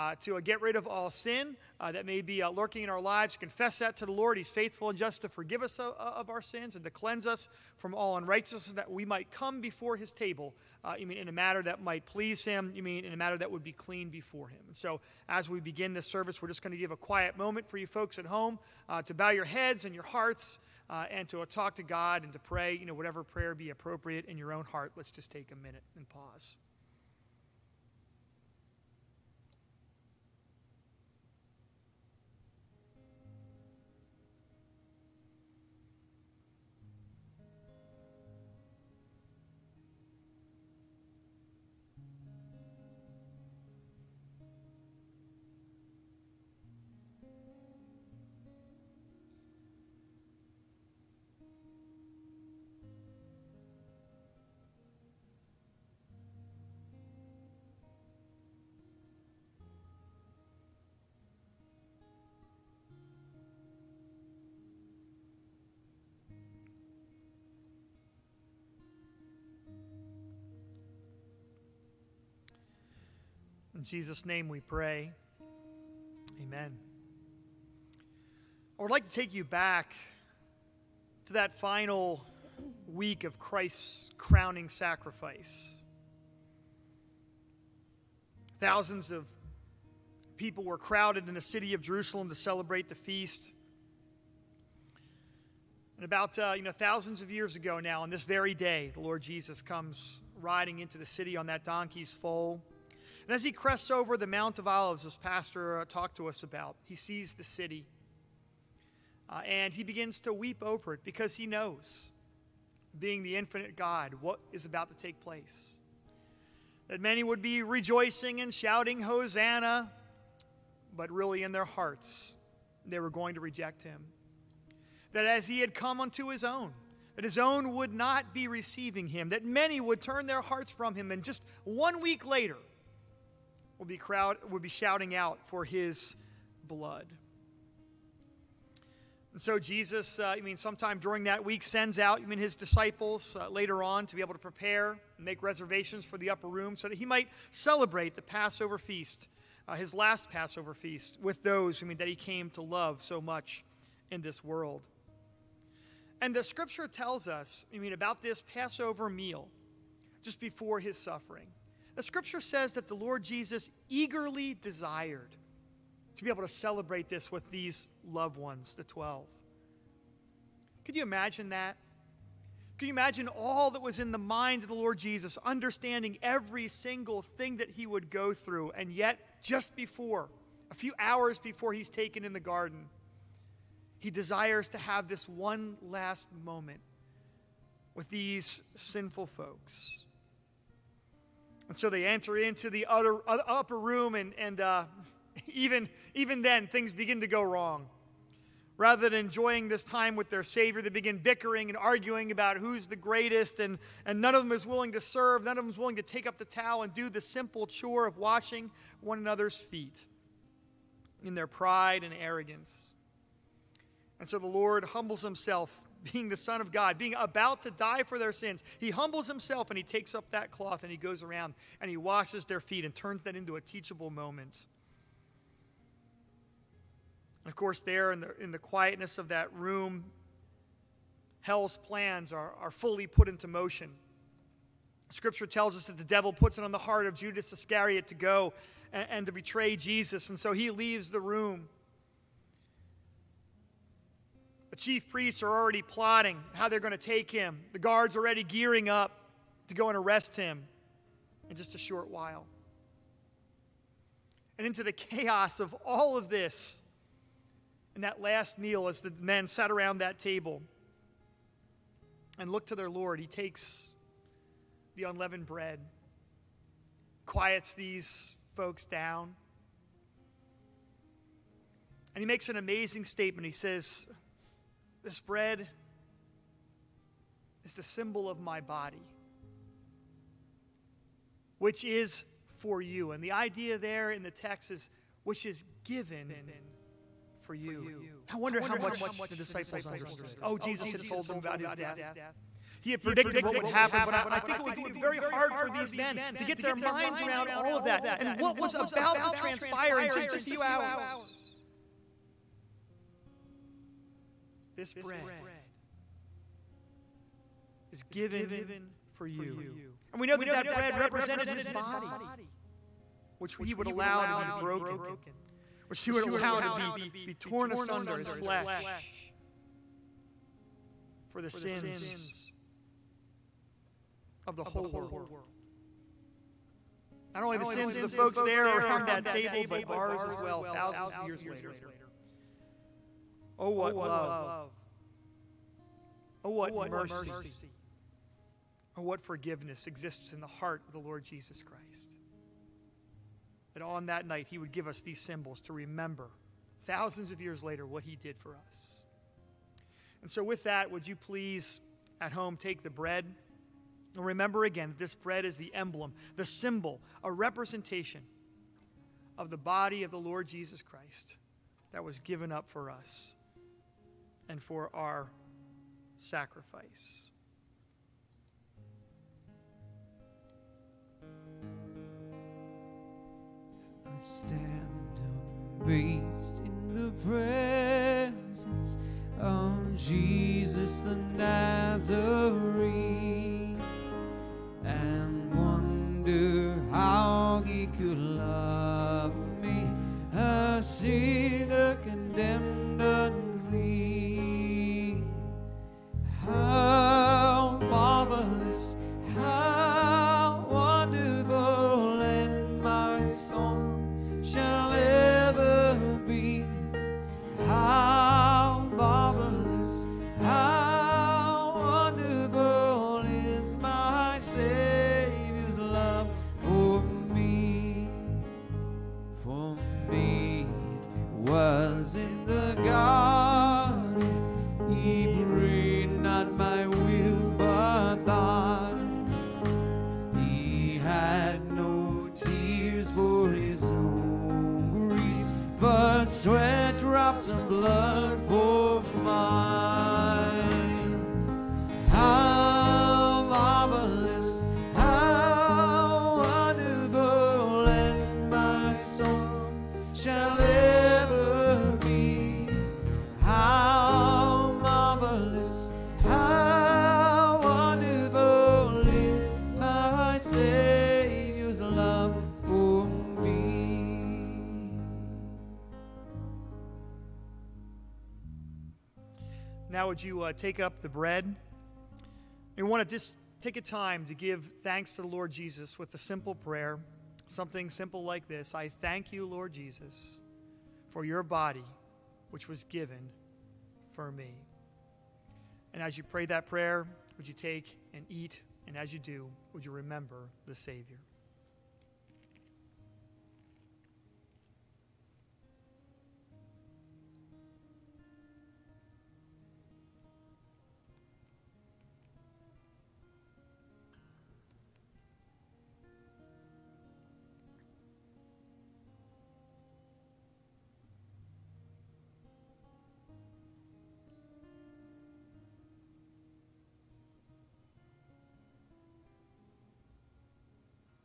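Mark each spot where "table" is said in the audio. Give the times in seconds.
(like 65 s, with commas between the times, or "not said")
10 s, 260 s, 329 s.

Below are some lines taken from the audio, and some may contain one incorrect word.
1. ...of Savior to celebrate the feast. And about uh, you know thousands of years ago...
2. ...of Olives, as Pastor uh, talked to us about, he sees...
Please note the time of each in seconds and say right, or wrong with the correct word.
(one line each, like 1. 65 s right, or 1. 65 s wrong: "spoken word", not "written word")
1. 91 s wrong: "Jerusalem", not "Savior"
2. 104 s right.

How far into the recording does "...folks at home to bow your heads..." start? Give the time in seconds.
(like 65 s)
17 s.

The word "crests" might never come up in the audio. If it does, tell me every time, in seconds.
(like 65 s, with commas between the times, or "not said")
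103 s.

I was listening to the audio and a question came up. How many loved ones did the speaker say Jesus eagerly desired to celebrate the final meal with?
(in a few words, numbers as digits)
12.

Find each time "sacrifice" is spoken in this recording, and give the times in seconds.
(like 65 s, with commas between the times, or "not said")
84 s, 366 s.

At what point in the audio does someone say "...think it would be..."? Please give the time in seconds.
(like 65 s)
294 s.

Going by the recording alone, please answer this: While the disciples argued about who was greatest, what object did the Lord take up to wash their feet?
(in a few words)
Cloth.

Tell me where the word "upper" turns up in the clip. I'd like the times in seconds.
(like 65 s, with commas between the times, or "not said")
146 s, 193 s.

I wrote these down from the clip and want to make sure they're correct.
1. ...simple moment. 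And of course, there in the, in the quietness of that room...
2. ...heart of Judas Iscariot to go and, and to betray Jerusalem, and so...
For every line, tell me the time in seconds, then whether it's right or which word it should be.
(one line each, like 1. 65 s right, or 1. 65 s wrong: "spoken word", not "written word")
1. 223 s wrong: "teachable", not "simple"
2. 236 s wrong: "Jesus", not "Jerusalem".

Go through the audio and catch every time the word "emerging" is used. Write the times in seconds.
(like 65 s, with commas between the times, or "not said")
not said.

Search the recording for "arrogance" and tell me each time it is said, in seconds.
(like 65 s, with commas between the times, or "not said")
212 s.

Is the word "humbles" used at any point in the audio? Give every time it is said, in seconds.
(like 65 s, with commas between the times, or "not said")
214 s, 218 s.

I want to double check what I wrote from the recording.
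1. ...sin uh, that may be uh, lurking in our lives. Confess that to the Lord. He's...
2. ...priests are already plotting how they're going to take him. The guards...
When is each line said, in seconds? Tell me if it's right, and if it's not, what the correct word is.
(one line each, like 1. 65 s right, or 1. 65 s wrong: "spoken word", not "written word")
1. 1 s right
2. 245 s right.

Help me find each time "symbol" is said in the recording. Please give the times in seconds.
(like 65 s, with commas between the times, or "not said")
277 s, 345 s, 356 s.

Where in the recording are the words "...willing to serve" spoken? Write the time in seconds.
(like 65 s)
204 s.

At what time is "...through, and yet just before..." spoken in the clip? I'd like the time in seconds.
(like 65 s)
178 s.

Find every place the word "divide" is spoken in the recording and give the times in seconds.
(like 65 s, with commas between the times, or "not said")
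not said.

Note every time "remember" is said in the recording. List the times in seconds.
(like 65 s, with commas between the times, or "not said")
345 s, 354 s, 489 s.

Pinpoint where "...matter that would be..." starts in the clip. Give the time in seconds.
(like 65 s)
13 s.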